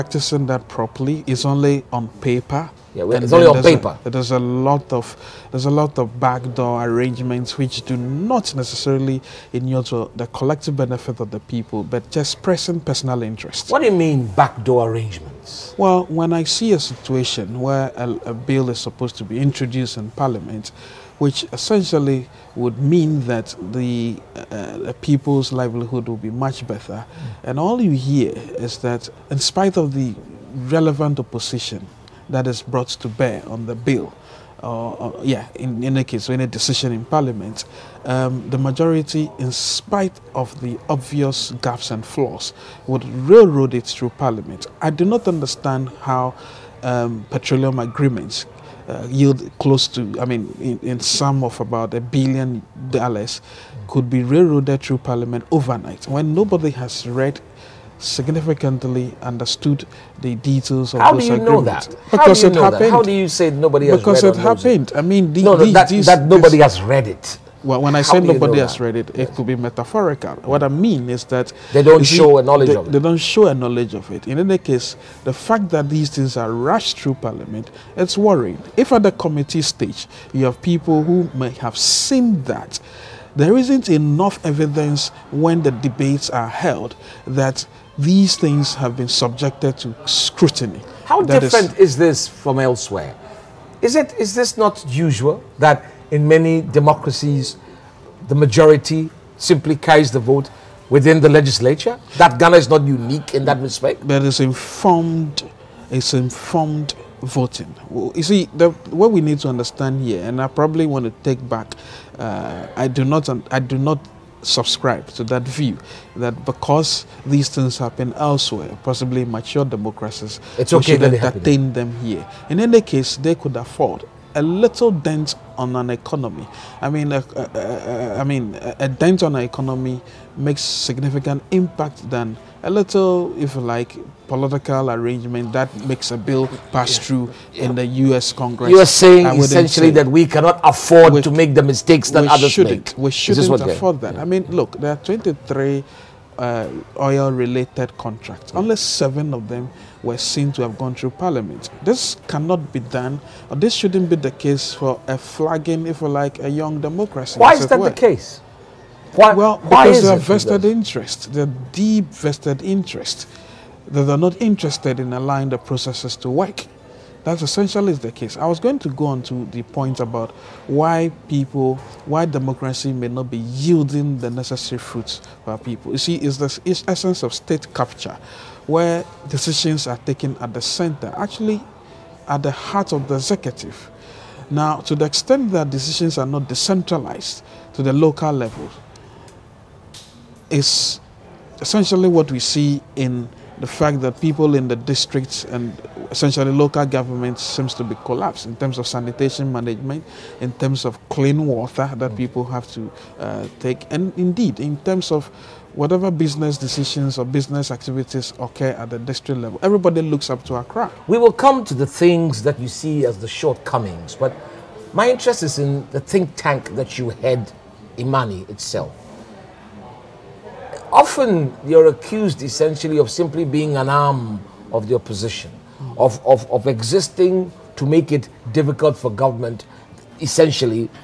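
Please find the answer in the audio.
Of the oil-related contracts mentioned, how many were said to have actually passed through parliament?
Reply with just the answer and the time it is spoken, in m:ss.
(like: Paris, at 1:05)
7, at 2:28.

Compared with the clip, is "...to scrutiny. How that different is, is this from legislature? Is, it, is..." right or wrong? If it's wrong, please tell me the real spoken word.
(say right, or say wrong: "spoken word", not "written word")
wrong: "elsewhere", not "legislature".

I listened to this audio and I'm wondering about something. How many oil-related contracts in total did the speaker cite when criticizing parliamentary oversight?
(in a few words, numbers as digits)
23.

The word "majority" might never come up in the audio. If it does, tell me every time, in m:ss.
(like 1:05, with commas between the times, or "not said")
0:38, 1:38.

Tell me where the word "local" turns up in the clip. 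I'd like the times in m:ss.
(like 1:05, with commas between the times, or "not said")
3:07, 3:16.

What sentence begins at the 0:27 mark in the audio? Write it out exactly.
and all you hear is that, in spite of the relevant opposition that is brought to bear on the bill.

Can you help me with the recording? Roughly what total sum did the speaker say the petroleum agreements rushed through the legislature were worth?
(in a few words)
about $1 billion.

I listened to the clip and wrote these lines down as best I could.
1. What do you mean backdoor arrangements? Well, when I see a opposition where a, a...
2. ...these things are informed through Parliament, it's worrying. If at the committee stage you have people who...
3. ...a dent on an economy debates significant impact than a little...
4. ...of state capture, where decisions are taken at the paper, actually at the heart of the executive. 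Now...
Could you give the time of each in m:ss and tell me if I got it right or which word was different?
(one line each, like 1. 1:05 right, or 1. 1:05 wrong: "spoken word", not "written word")
1. 0:13 wrong: "situation", not "opposition"
2. 1:15 wrong: "rushed", not "informed"
3. 2:08 wrong: "makes", not "debates"
4. 2:57 wrong: "center", not "paper".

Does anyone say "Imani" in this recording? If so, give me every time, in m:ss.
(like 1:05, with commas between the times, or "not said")
3:37.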